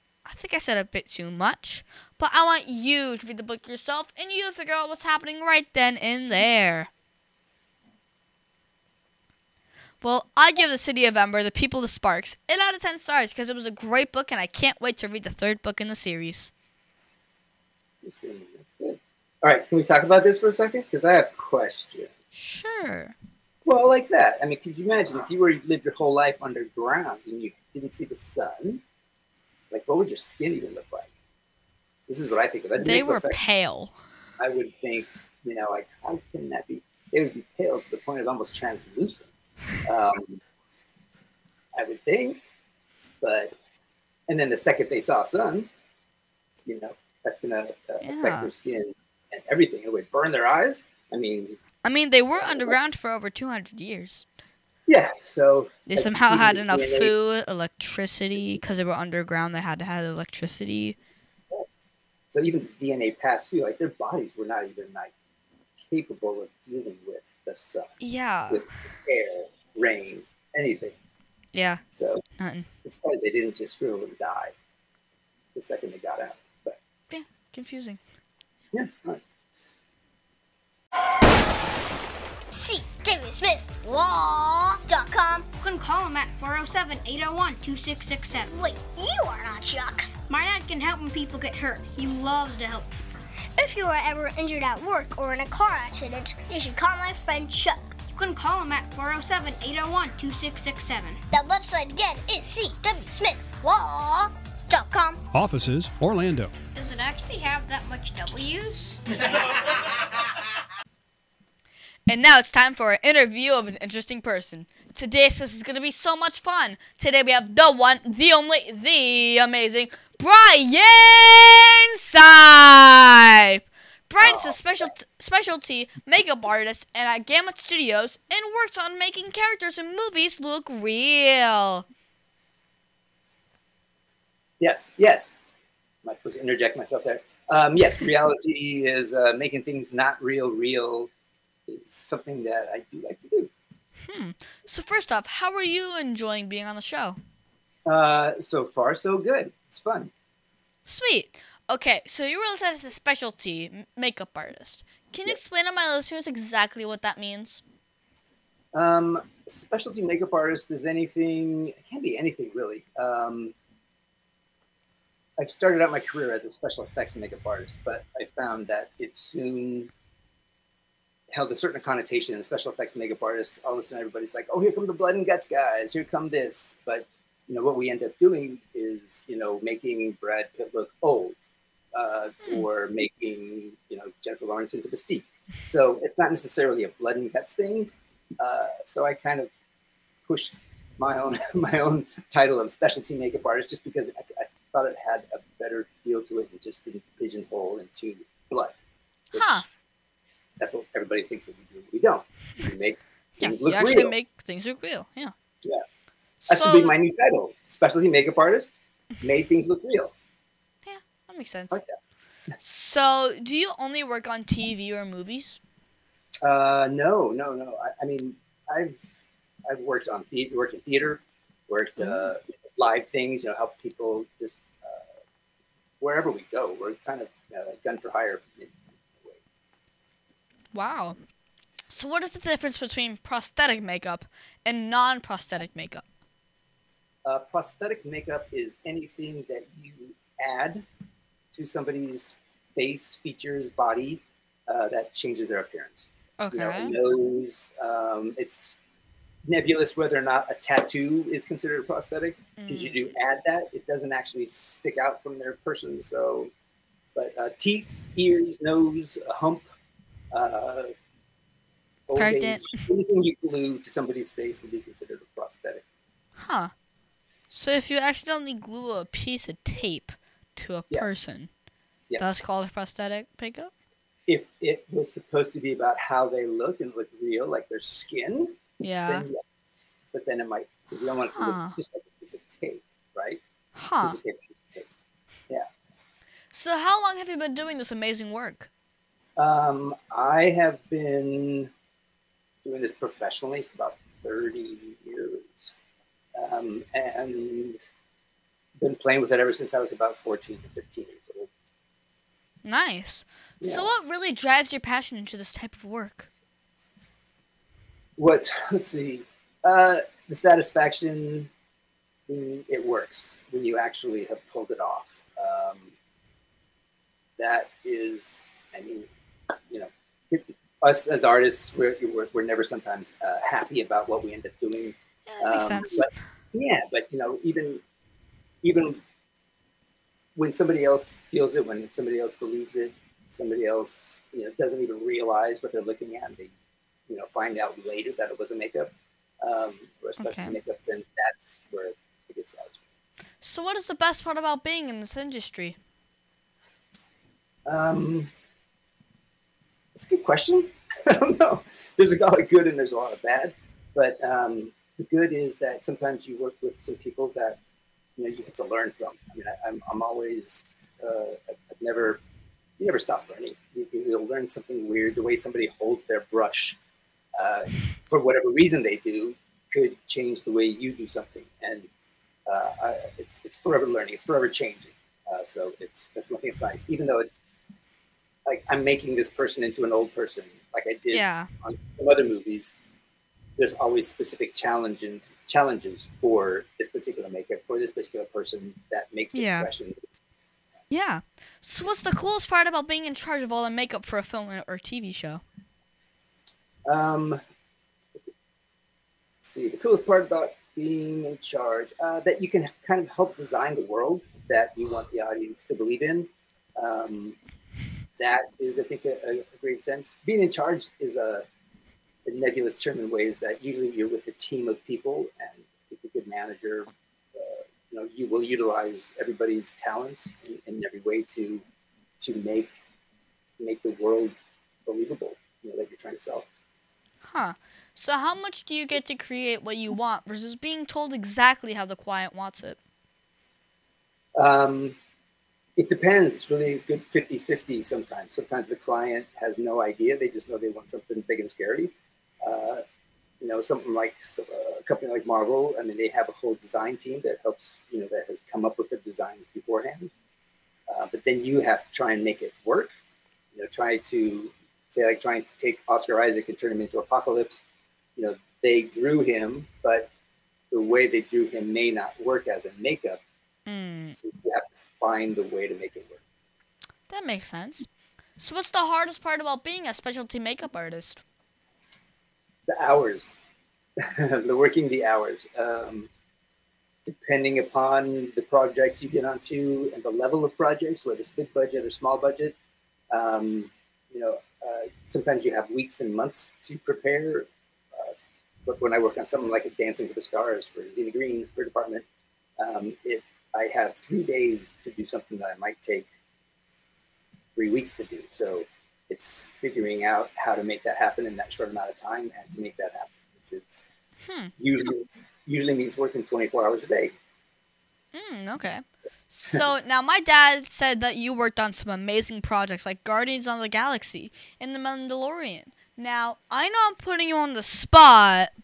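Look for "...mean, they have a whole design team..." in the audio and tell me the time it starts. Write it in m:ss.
7:25.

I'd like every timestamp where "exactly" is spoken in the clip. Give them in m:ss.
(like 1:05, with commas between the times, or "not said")
2:36, 7:11.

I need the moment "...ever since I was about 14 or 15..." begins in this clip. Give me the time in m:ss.
4:59.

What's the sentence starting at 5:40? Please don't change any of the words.
makeup, then that's where it gets out.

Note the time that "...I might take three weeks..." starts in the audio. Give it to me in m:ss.
8:15.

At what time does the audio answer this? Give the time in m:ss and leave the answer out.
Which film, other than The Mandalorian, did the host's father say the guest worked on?
8:33.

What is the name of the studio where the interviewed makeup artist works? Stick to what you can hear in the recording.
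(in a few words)
Gamut Studios.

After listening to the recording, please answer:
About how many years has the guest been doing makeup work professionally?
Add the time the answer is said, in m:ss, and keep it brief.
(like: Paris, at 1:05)
30, at 4:53.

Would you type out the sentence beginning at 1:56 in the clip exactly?
Today we have the one, the only, the amazing Brian Sipe.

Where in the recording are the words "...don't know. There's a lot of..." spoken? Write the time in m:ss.
5:51.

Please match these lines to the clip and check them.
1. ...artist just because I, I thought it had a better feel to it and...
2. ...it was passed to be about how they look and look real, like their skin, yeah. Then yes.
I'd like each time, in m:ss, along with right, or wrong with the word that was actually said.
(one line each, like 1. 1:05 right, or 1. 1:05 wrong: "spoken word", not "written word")
1. 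3:13 right
2. 4:34 wrong: "supposed", not "passed".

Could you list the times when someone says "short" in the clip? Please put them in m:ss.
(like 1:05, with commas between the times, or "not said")
8:21.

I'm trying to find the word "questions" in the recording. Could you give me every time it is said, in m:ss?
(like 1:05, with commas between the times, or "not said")
0:21, 5:50.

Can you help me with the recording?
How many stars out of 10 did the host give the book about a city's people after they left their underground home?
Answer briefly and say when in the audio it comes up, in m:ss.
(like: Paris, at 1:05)
8, at 0:12.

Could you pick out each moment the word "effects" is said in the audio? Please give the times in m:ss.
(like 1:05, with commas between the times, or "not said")
2:46, 2:52.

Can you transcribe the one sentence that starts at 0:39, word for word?
Um, I would think, but and then the second they saw sun, you know, that's gonna uh, yeah.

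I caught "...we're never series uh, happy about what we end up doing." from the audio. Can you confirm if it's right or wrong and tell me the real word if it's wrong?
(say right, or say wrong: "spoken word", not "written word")
wrong: "sometimes", not "series".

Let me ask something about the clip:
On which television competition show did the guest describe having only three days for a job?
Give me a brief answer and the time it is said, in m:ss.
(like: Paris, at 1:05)
Dancing with the Stars, at 8:09.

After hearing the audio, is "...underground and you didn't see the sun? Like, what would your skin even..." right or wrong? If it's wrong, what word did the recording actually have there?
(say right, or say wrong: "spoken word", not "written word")
right.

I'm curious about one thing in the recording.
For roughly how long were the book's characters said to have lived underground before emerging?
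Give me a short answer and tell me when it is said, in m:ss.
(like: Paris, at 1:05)
over 200 years, at 0:53.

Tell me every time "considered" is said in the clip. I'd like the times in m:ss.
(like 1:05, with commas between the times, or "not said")
4:11, 4:24.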